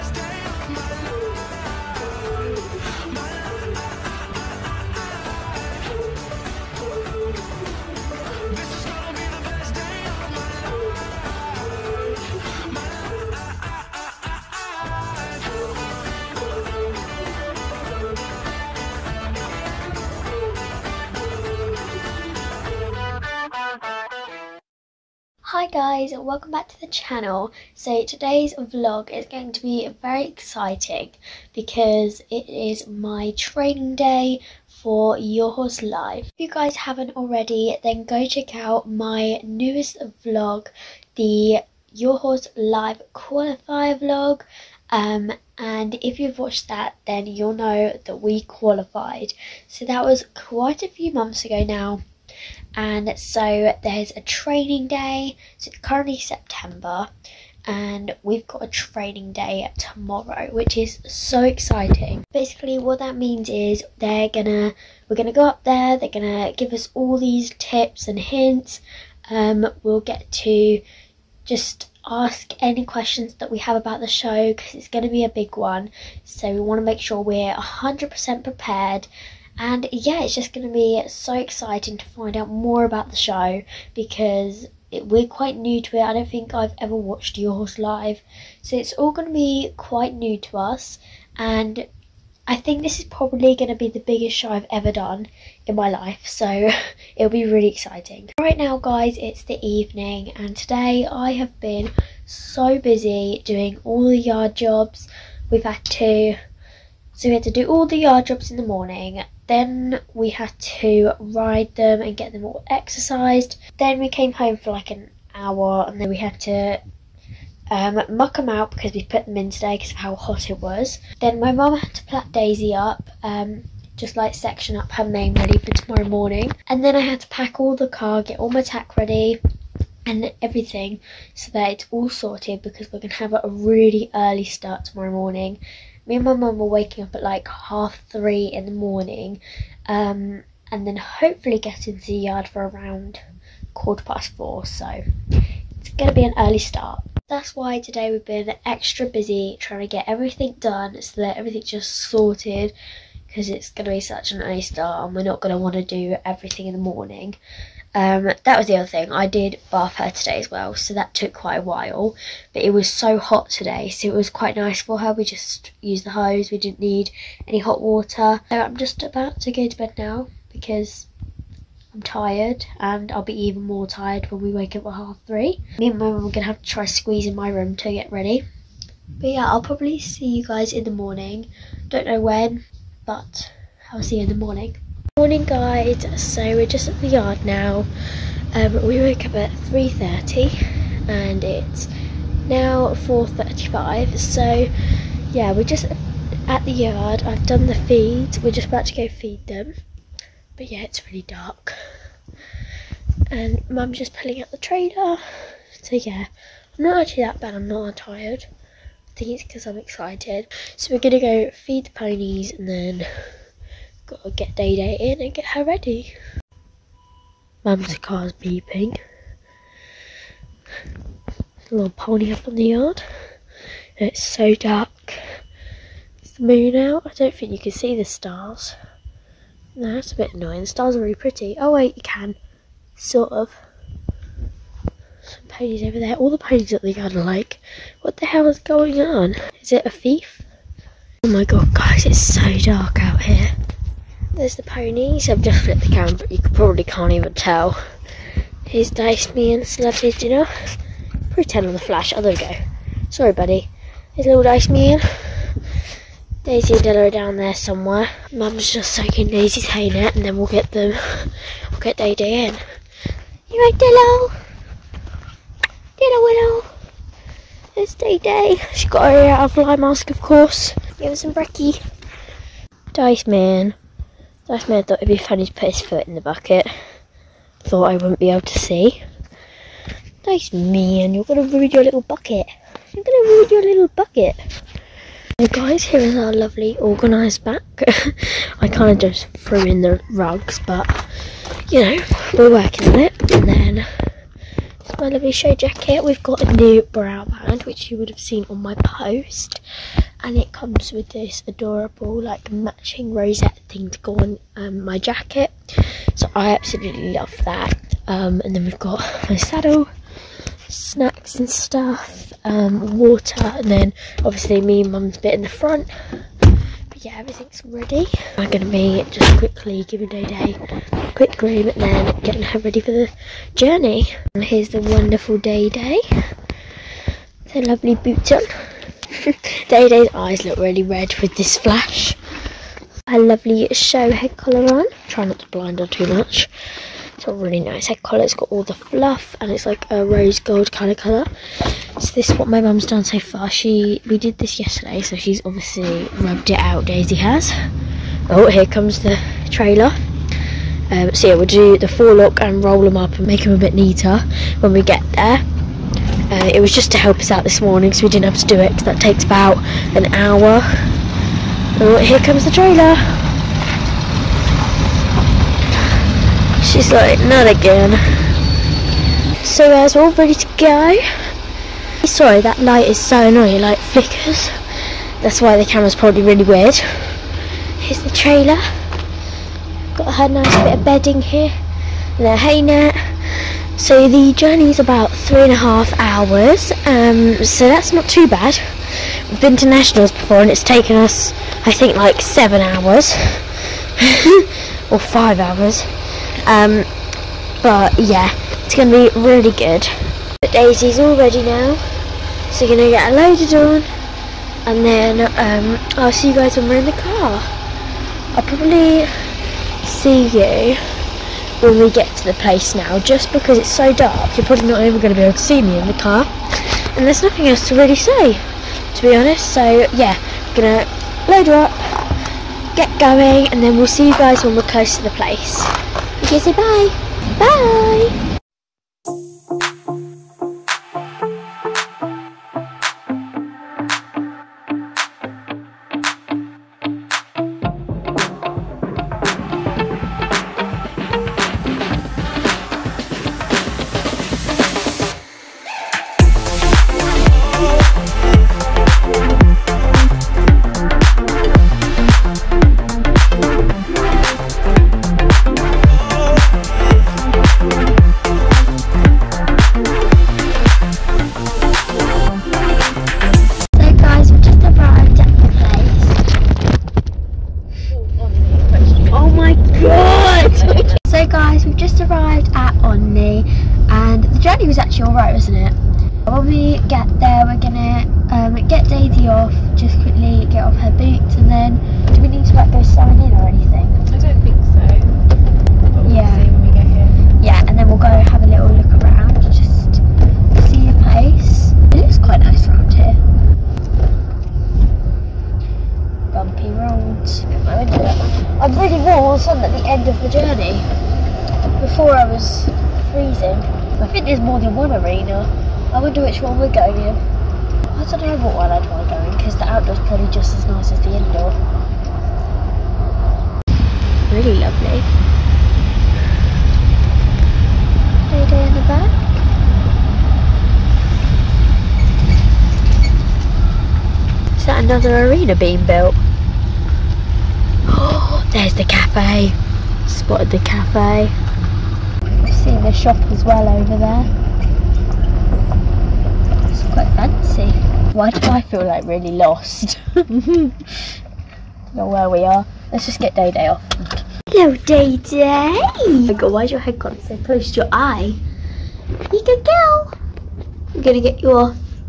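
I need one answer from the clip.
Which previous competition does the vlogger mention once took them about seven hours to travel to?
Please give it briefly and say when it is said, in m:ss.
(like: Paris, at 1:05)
nationals, at 6:29.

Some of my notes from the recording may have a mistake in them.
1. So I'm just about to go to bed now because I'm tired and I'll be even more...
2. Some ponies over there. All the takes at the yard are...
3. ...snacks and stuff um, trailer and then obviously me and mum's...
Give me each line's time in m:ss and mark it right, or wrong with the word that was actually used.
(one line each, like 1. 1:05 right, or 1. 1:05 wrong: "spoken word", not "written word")
1. 2:48 right
2. 3:55 wrong: "ponies", not "takes"
3. 5:10 wrong: "water", not "trailer".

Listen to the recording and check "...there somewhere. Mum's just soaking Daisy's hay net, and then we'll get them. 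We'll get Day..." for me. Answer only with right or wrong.
right.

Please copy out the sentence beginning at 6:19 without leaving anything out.
Got her nice bit of bedding here.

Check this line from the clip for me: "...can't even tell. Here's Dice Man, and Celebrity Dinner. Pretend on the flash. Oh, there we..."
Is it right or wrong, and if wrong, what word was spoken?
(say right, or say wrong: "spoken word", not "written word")
right.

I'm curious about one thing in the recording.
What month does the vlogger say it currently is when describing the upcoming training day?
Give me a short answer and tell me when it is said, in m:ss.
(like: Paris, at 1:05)
September, at 0:56.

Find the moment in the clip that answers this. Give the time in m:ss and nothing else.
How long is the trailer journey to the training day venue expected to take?
6:25.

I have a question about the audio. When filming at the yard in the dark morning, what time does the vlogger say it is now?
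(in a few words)
4:35.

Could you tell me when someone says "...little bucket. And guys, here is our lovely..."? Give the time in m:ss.
4:43.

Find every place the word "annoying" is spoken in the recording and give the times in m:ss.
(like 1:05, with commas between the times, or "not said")
3:50, 6:13.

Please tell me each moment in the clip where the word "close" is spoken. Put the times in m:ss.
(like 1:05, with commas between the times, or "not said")
7:04, 9:07.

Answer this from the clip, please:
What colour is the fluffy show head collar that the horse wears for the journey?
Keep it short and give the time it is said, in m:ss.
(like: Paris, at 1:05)
rose gold, at 5:40.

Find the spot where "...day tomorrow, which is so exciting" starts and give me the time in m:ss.
0:59.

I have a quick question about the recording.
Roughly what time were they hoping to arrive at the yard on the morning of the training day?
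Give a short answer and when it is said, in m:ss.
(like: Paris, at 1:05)
quarter past four, at 2:23.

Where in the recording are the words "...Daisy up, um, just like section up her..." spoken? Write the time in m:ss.
2:02.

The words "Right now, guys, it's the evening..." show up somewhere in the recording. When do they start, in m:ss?
1:38.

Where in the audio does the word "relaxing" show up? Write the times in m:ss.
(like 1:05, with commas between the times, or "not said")
not said.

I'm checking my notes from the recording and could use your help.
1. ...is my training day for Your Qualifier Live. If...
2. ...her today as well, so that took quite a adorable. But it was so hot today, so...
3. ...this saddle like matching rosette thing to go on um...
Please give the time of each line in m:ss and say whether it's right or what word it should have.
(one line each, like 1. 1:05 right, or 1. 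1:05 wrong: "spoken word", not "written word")
1. 0:32 wrong: "Horse", not "Qualifier"
2. 2:39 wrong: "while", not "adorable"
3. 5:01 wrong: "adorable", not "saddle".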